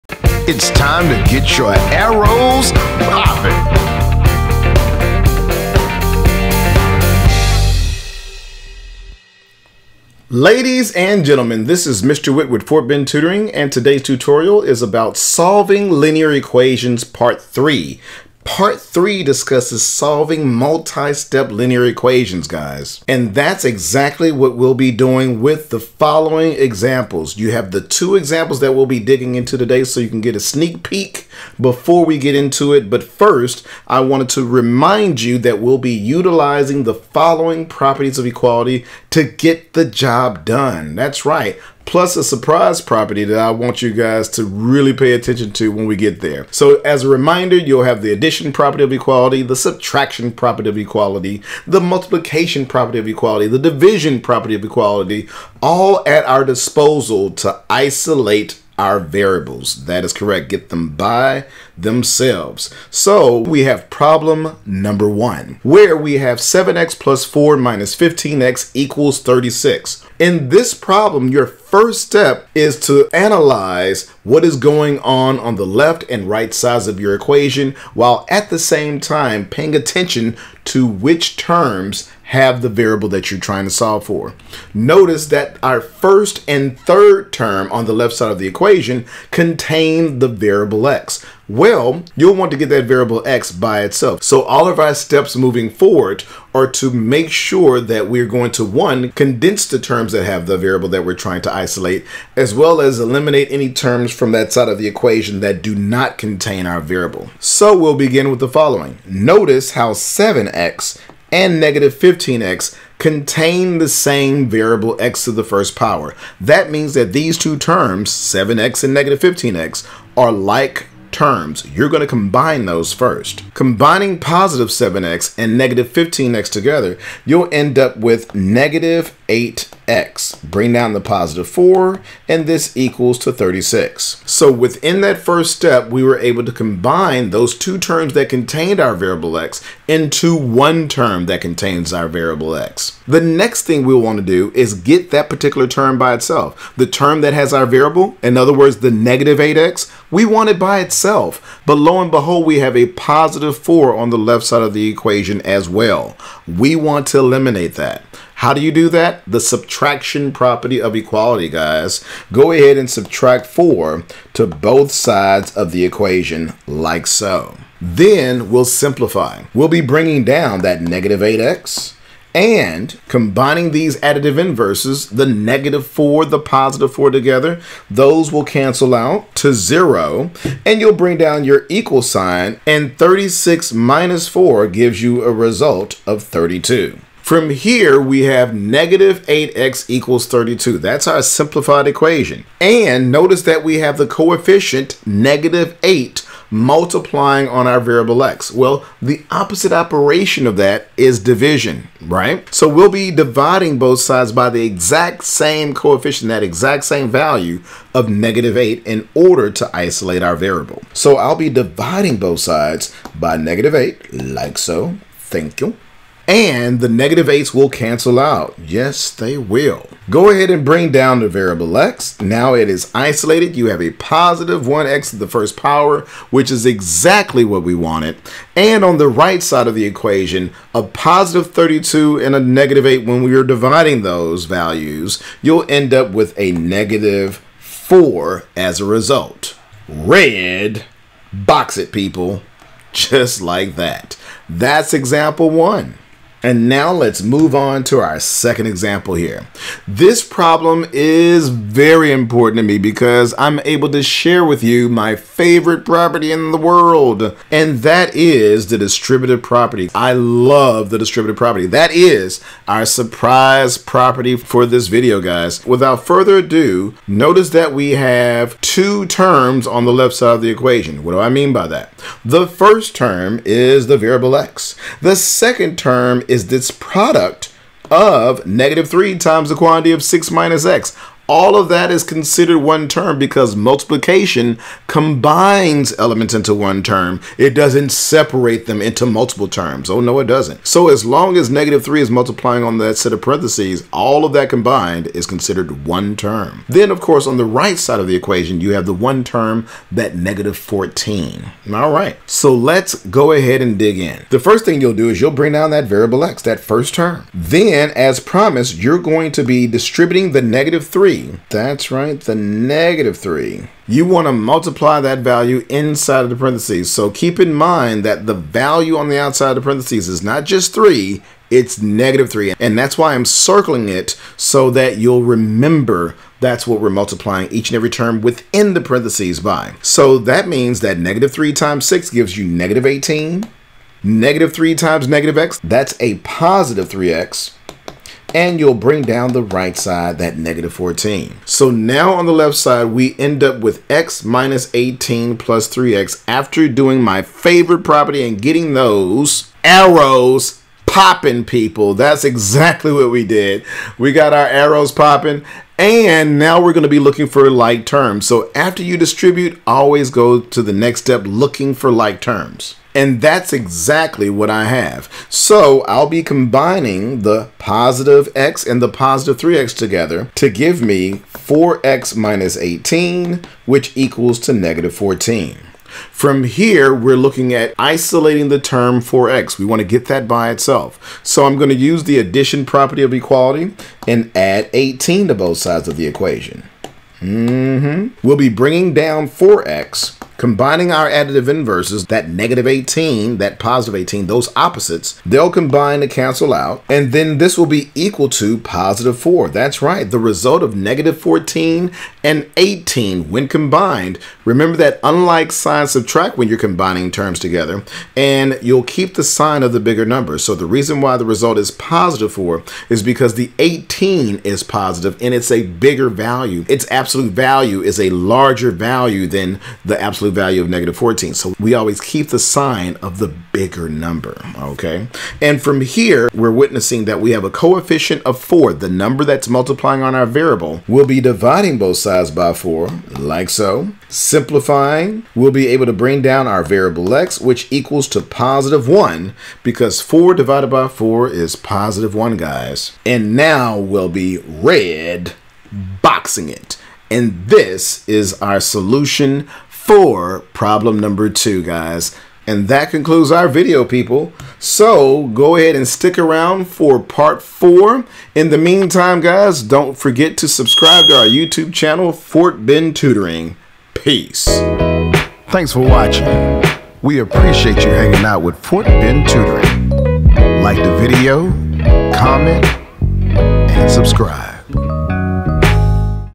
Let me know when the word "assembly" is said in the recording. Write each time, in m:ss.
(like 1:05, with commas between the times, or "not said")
not said.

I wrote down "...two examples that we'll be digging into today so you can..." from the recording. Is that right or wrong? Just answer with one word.
right.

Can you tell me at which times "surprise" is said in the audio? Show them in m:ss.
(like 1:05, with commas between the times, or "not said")
0:42, 4:22.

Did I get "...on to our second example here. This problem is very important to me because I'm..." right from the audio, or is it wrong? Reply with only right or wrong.
right.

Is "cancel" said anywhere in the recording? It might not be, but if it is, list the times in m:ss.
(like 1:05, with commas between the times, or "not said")
2:58, 3:37, 6:36.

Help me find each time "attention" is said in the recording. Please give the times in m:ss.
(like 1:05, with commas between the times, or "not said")
0:45, 1:19.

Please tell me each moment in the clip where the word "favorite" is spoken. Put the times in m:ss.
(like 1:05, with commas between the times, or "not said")
4:15, 5:47.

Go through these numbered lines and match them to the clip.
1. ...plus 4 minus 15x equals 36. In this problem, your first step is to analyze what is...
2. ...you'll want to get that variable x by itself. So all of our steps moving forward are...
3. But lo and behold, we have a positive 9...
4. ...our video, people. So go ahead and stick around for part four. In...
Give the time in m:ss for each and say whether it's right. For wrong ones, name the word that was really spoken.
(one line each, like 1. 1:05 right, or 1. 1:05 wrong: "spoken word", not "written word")
1. 1:06 right
2. 1:32 right
3. 2:31 wrong: "4", not "9"
4. 7:33 right.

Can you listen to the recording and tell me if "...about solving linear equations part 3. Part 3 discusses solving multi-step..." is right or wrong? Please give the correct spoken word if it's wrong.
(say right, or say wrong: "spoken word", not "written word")
right.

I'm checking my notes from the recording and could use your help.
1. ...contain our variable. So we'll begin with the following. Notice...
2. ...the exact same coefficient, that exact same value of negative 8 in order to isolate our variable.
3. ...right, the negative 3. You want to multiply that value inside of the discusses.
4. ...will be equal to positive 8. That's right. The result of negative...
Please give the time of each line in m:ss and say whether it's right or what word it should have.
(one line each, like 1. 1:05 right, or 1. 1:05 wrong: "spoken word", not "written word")
1. 1:46 right
2. 3:24 right
3. 5:11 wrong: "parentheses", not "discusses"
4. 6:37 wrong: "4", not "8".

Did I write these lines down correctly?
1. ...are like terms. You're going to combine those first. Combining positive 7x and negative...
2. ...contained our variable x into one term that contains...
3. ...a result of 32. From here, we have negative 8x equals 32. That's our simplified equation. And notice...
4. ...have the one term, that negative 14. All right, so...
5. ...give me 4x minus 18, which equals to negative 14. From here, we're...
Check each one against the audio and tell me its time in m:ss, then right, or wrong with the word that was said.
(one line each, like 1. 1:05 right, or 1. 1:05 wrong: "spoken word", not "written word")
1. 2:00 right
2. 2:18 right
3. 3:05 right
4. 4:58 right
5. 6:10 right.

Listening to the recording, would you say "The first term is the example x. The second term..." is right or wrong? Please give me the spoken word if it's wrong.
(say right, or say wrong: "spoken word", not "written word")
wrong: "variable", not "example".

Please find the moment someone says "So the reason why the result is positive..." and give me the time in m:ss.
6:50.